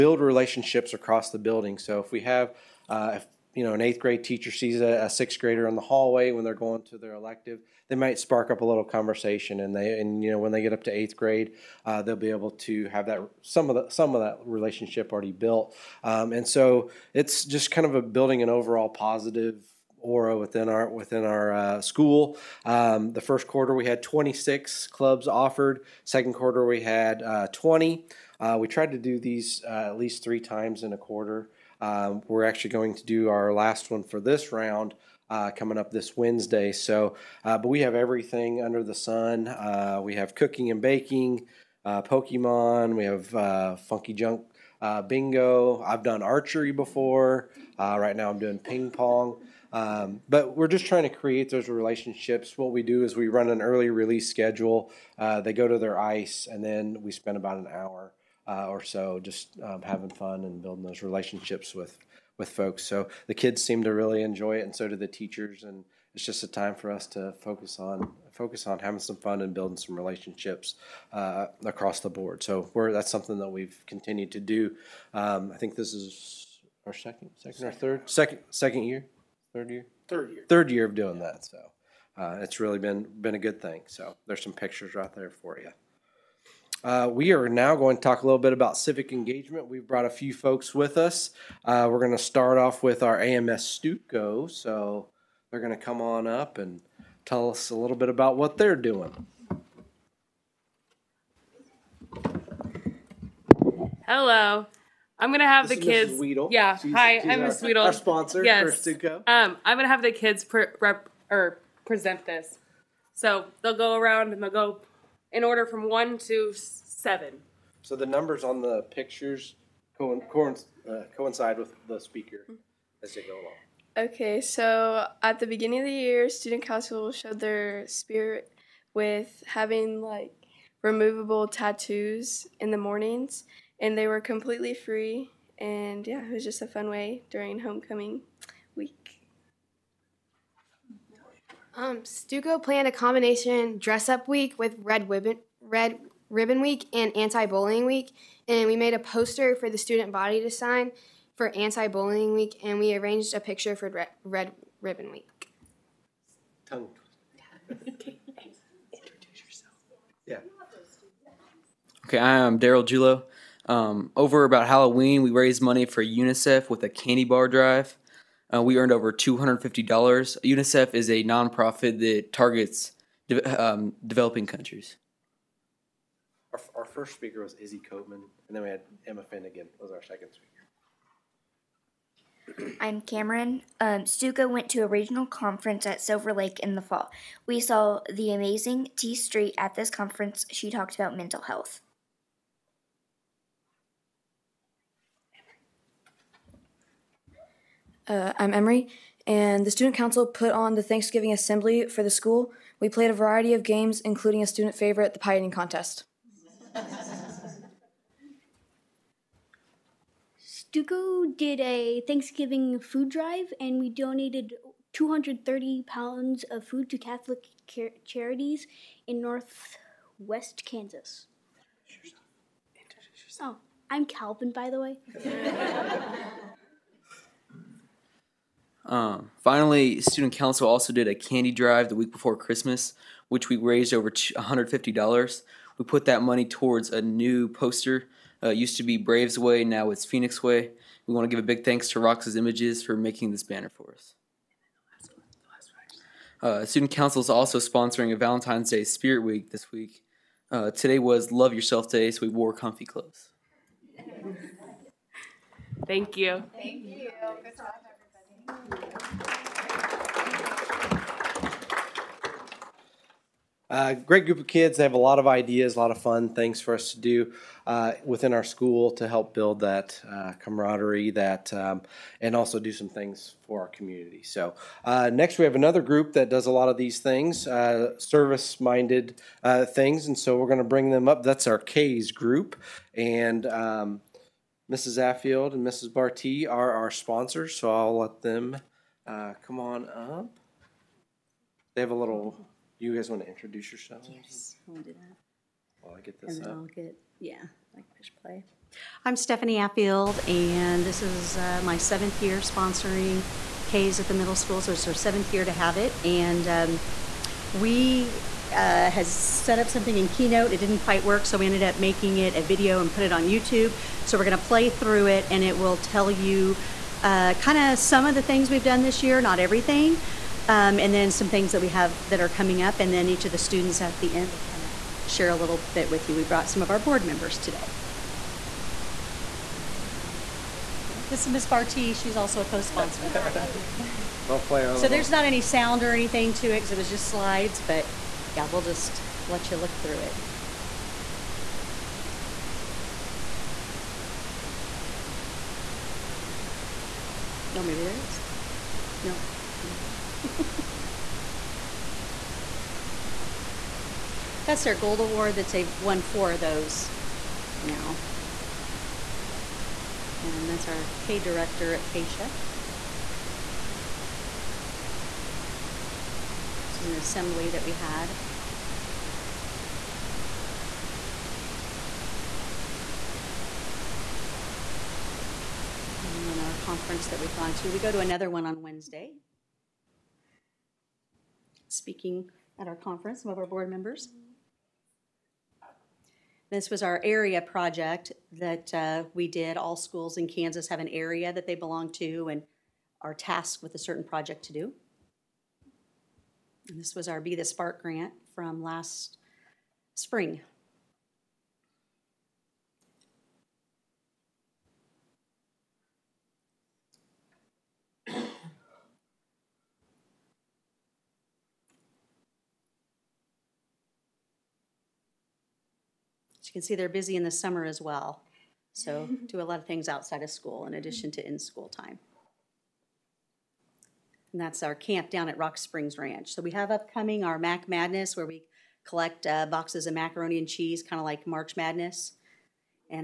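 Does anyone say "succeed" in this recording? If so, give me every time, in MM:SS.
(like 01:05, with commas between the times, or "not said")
not said.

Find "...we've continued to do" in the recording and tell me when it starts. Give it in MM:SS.
01:13.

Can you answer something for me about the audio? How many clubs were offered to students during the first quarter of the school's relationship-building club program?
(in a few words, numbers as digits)
26.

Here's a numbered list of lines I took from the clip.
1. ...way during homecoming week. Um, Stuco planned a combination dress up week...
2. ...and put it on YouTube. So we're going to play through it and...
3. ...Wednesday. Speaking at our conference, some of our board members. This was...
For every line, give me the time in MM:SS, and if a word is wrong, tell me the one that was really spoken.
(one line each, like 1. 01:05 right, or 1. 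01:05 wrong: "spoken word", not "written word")
1. 02:16 right
2. 05:12 right
3. 06:18 right.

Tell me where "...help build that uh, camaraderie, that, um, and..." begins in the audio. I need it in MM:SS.
04:29.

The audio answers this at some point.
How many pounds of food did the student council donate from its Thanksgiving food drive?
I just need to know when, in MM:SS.
03:34.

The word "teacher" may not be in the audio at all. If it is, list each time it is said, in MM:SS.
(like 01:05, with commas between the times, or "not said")
00:04, 01:05.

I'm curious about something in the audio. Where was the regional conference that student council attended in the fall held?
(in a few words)
Silver Lake.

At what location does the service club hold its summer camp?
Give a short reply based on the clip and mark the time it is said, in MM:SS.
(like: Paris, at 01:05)
Rock Springs Ranch, at 07:05.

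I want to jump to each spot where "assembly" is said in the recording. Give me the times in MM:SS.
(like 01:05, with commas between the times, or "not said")
03:21, 06:06.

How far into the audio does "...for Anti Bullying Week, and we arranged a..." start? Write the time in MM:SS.
02:31.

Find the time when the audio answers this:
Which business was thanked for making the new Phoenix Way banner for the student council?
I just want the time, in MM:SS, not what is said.
04:01.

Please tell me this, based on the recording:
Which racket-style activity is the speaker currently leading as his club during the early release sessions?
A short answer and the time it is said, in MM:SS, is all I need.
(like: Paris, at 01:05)
ping pong, at 00:48.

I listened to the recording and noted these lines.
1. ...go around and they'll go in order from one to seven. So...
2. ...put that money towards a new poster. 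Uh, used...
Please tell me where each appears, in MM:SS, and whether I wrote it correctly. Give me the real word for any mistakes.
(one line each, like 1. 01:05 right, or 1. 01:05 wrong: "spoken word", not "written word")
1. 01:53 right
2. 03:55 right.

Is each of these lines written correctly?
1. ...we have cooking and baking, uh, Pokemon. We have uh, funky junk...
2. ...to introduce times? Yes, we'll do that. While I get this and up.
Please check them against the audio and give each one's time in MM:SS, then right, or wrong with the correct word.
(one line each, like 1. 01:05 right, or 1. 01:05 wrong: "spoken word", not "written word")
1. 00:40 right
2. 04:53 wrong: "yourselves", not "times".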